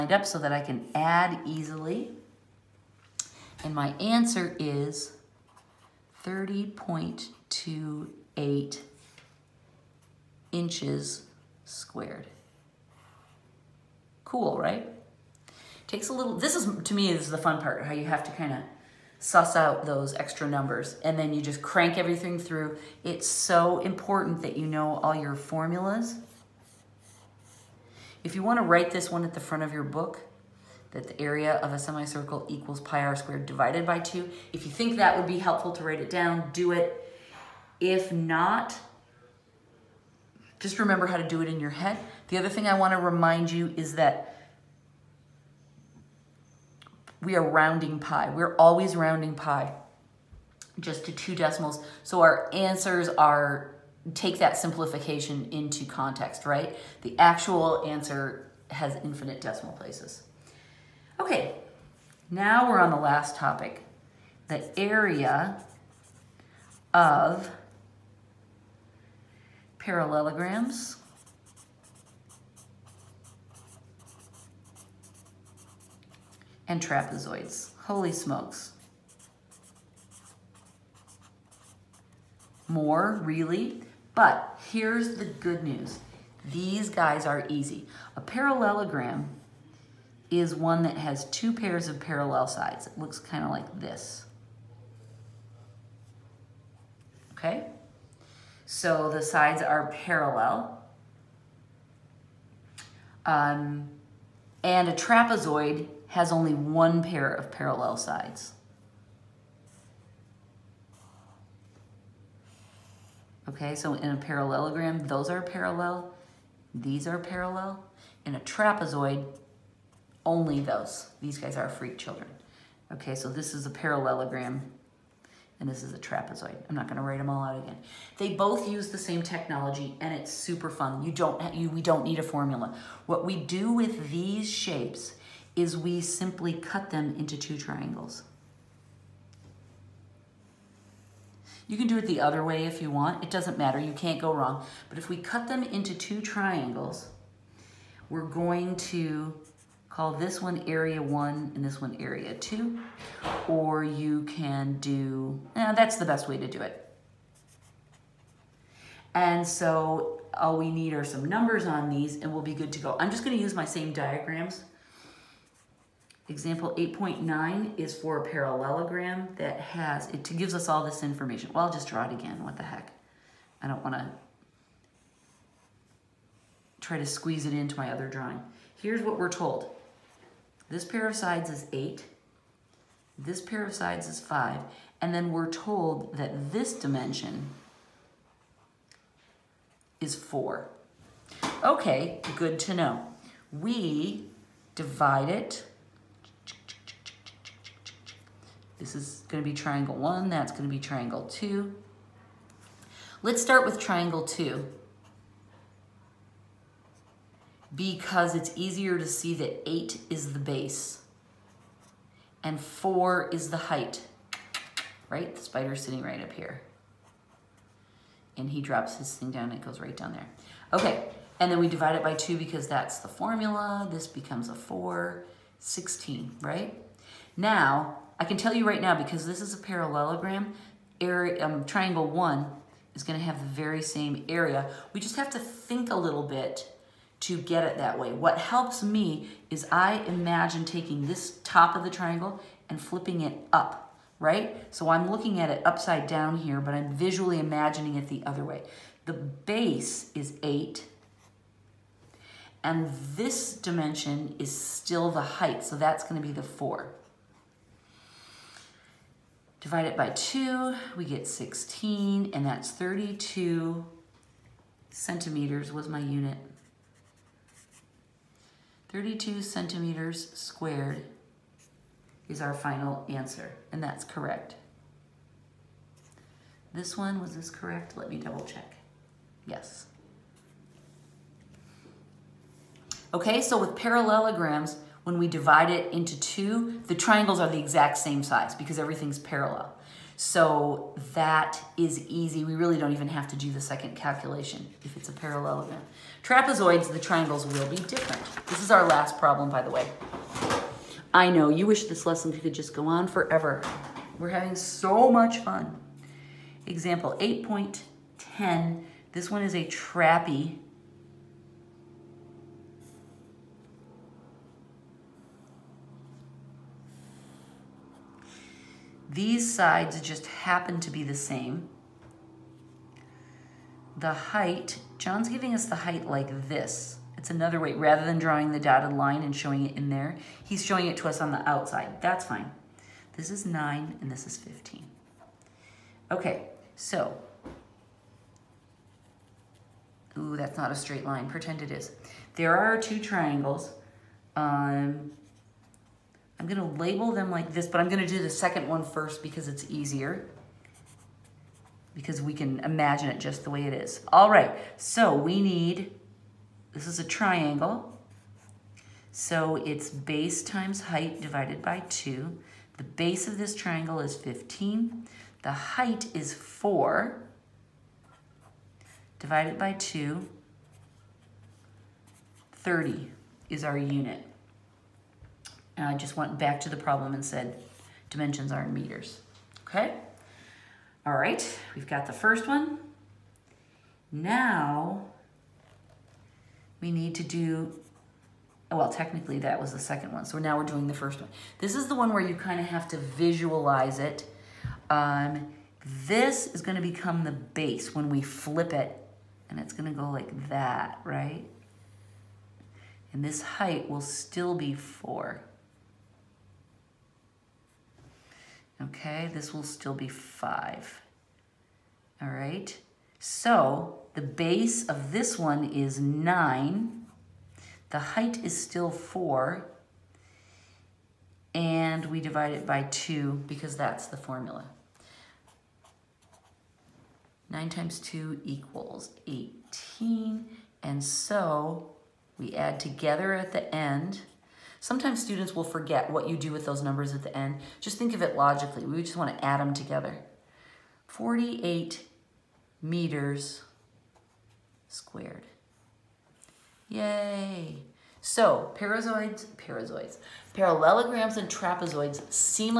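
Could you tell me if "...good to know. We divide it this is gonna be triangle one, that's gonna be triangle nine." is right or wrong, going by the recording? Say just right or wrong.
wrong.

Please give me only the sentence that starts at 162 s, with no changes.
I'm just gonna use my same diagrams Example 8.9 is for a parallelogram that has, it gives us all this information.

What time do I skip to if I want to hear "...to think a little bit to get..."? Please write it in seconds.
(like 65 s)
235 s.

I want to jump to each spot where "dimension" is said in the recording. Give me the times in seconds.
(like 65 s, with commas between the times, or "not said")
186 s, 253 s, 378 s.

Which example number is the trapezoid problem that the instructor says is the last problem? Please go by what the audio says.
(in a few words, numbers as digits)
8.10.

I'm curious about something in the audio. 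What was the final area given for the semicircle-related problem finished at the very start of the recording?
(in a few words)
30.28 inches squared.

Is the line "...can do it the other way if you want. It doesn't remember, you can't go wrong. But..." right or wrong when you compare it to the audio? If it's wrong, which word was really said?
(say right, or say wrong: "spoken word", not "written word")
wrong: "matter", not "remember".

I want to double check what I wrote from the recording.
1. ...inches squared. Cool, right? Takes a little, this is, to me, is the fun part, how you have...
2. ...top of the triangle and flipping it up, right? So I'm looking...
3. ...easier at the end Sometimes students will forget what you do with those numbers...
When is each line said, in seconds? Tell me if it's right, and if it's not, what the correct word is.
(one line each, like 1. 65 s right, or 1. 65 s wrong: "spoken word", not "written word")
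1. 10 s right
2. 241 s right
3. 432 s wrong: "together", not "easier".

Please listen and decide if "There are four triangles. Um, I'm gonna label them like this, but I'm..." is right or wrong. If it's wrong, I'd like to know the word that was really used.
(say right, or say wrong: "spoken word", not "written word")
wrong: "two", not "four".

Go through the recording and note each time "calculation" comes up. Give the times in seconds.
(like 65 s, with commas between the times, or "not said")
293 s.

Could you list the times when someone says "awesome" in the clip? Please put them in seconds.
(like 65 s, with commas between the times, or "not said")
not said.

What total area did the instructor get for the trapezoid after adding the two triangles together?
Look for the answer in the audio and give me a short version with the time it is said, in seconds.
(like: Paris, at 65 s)
48 meters squared, at 441 s.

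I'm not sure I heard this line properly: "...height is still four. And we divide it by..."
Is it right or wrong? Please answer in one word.
right.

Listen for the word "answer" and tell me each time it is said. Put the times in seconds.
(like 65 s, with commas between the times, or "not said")
3 s, 52 s, 57 s, 273 s.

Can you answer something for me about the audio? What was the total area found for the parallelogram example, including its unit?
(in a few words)
32 centimeters squared.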